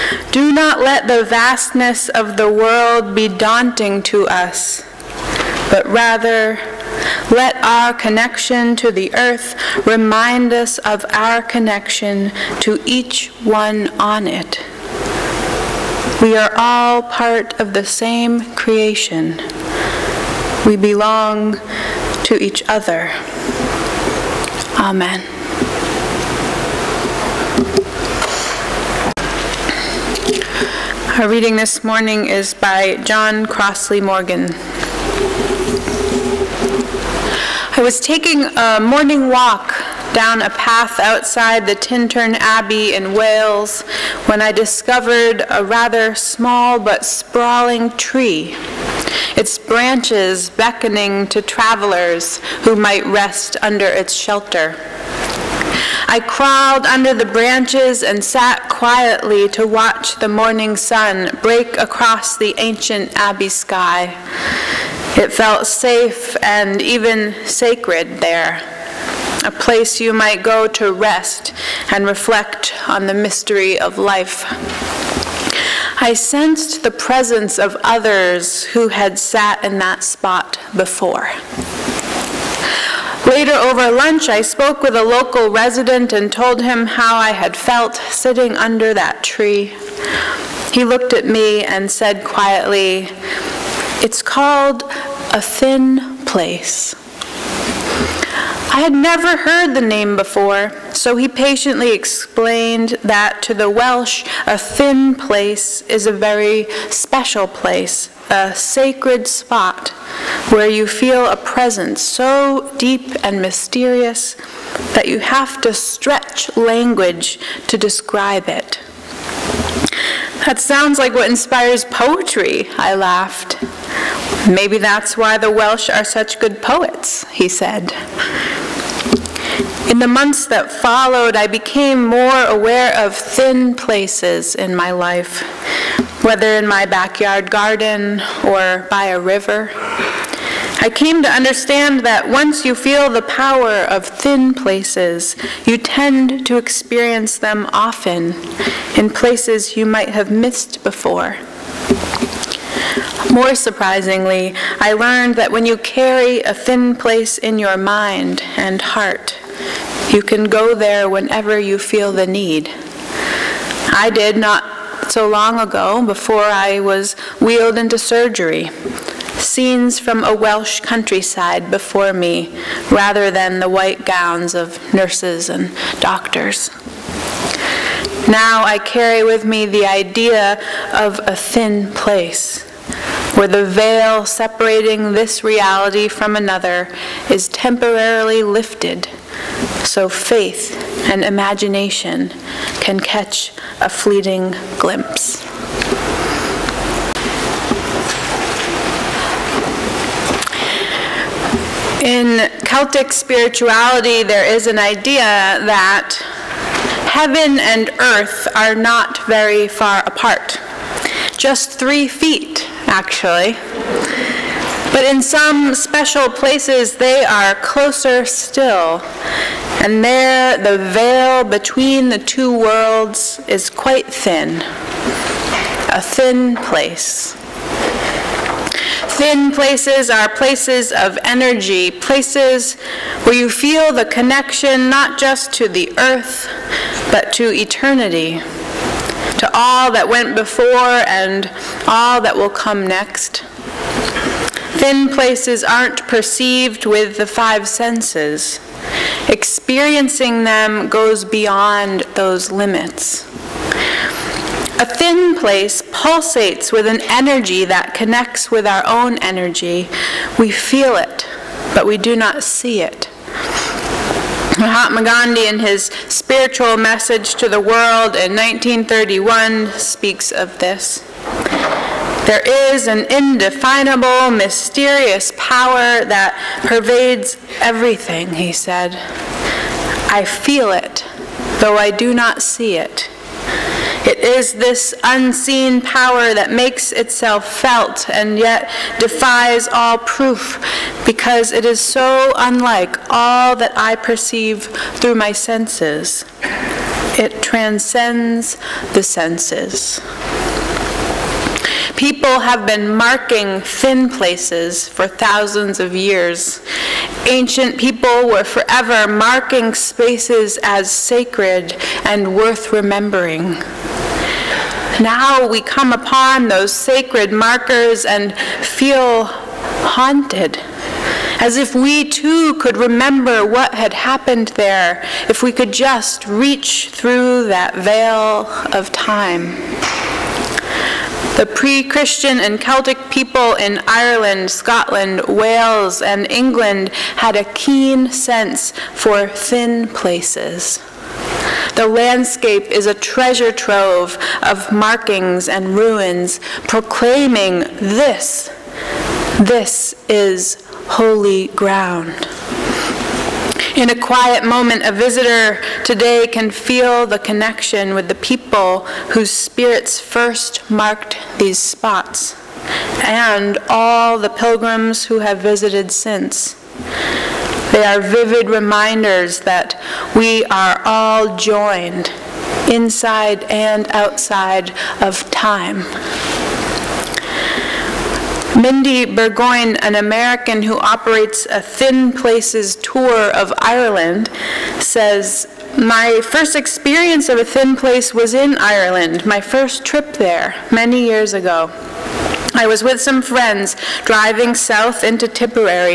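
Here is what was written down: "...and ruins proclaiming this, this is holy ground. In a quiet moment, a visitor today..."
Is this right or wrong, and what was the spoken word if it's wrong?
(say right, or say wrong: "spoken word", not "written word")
right.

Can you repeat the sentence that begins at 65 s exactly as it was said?
It felt safe and even sacred there, a place you might go to rest and reflect on the mystery of life.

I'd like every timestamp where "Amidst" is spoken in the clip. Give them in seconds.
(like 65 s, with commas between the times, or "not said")
not said.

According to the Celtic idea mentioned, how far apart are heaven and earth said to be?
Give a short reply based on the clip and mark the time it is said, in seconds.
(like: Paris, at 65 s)
3 feet, at 211 s.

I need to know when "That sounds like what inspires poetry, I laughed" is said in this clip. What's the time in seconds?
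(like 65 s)
120 s.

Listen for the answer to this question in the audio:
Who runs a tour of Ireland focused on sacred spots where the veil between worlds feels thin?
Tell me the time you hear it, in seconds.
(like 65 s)
378 s.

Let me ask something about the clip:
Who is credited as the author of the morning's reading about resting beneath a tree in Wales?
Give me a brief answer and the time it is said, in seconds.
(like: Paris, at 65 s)
John Crossley Morgan, at 33 s.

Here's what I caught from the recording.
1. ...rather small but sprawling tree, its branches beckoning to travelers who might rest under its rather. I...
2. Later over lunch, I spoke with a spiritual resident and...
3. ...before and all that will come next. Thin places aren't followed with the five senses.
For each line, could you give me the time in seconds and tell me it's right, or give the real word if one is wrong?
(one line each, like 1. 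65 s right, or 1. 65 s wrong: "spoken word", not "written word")
1. 45 s wrong: "shelter", not "rather"
2. 83 s wrong: "local", not "spiritual"
3. 240 s wrong: "perceived", not "followed".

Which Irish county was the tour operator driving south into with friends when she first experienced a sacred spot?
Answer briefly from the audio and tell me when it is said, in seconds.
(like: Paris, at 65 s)
Tipperary, at 395 s.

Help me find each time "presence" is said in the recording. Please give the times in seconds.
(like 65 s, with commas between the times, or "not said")
76 s, 111 s.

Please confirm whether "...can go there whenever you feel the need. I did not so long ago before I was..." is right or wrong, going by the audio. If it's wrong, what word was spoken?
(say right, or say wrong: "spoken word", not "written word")
right.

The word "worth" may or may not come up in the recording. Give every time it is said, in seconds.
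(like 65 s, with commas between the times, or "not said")
312 s.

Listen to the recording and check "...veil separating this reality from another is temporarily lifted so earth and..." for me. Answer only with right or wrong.
wrong.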